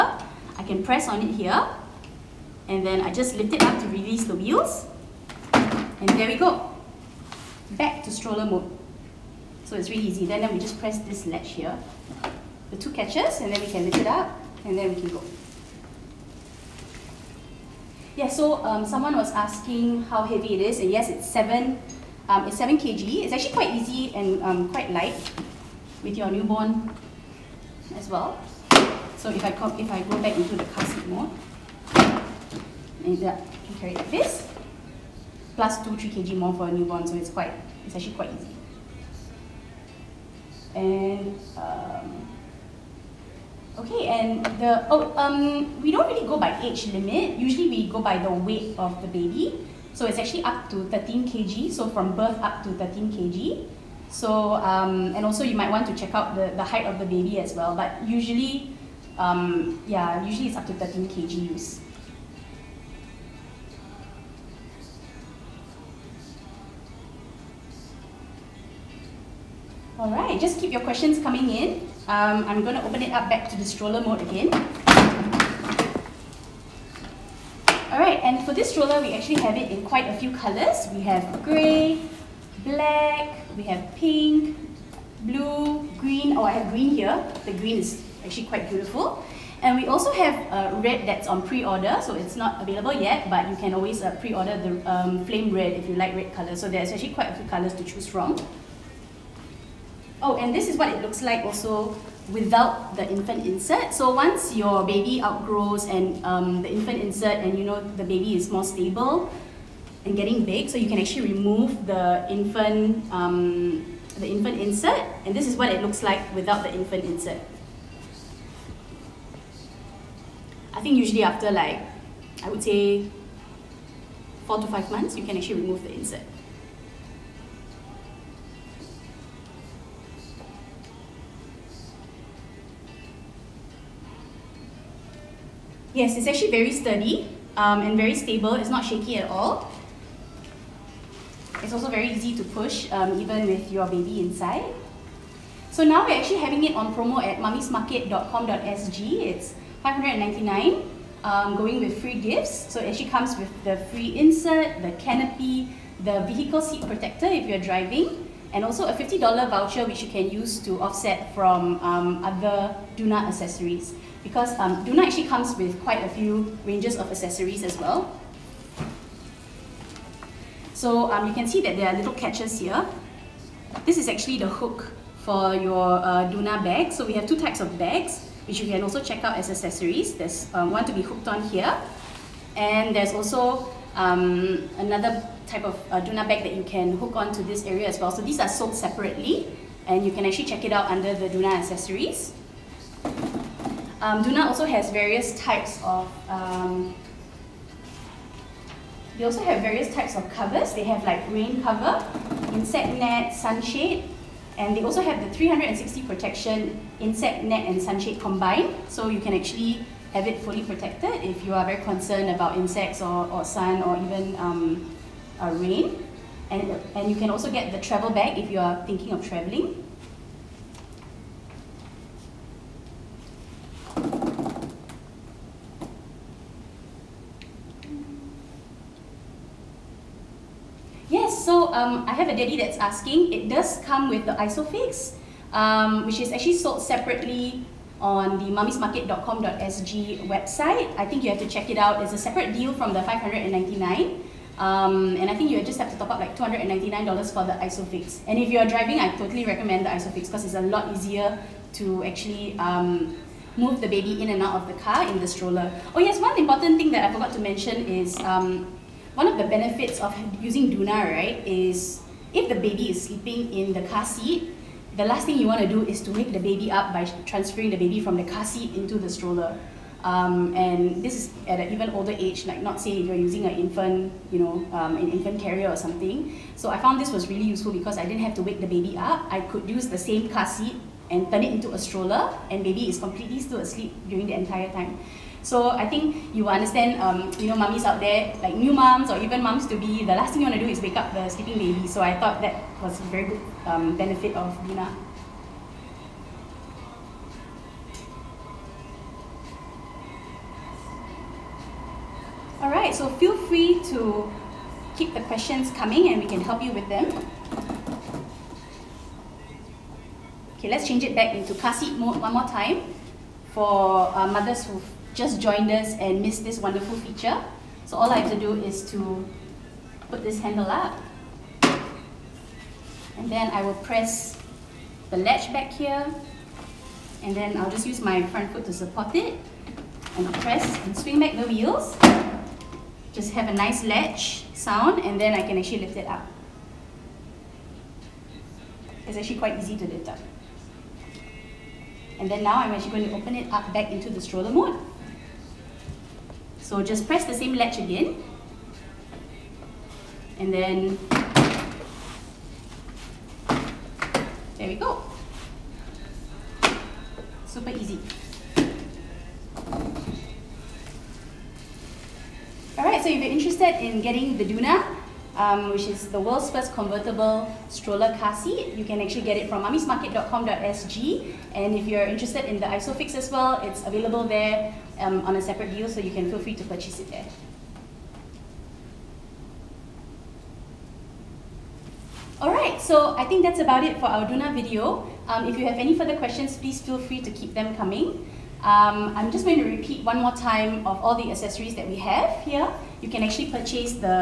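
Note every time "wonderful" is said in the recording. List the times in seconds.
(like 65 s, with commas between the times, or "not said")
316 s.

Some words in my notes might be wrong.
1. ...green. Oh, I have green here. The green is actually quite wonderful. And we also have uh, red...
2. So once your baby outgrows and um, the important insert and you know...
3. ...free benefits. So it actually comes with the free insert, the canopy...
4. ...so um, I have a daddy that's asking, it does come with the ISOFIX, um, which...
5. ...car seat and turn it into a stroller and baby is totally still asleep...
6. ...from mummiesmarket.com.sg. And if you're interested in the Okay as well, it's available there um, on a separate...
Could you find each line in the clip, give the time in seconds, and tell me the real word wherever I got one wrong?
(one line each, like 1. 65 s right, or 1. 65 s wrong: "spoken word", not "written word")
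1. 86 s wrong: "beautiful", not "wonderful"
2. 103 s wrong: "infant", not "important"
3. 151 s wrong: "gifts", not "benefits"
4. 231 s right
5. 280 s wrong: "completely", not "totally"
6. 369 s wrong: "ISOFix", not "Okay".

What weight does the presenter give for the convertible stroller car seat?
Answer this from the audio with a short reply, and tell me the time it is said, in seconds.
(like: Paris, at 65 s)
7 kg, at 22 s.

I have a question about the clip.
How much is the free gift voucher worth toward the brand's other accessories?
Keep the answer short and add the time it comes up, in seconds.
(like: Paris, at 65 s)
$50, at 158 s.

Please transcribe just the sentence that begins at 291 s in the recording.
So I thought that was a very good um, benefit of Doona.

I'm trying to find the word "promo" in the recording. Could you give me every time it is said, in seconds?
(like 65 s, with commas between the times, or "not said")
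146 s.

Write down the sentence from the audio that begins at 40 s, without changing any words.
And um, Okay, and the oh um we don't really go by age limit.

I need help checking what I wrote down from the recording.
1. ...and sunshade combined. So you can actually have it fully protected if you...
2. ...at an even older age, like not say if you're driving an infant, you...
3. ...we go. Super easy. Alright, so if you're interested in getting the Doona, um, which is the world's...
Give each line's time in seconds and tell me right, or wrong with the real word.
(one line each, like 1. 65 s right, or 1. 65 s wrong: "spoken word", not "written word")
1. 207 s right
2. 271 s wrong: "using", not "driving"
3. 354 s right.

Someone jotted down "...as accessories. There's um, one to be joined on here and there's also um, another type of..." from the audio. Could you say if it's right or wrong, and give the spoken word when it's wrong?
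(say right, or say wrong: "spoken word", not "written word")
wrong: "hooked", not "joined".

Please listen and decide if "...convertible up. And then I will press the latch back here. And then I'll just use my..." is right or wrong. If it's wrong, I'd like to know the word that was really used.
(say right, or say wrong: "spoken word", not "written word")
wrong: "handle", not "convertible".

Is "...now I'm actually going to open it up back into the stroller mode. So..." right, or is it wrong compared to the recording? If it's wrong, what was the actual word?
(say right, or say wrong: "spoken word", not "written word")
right.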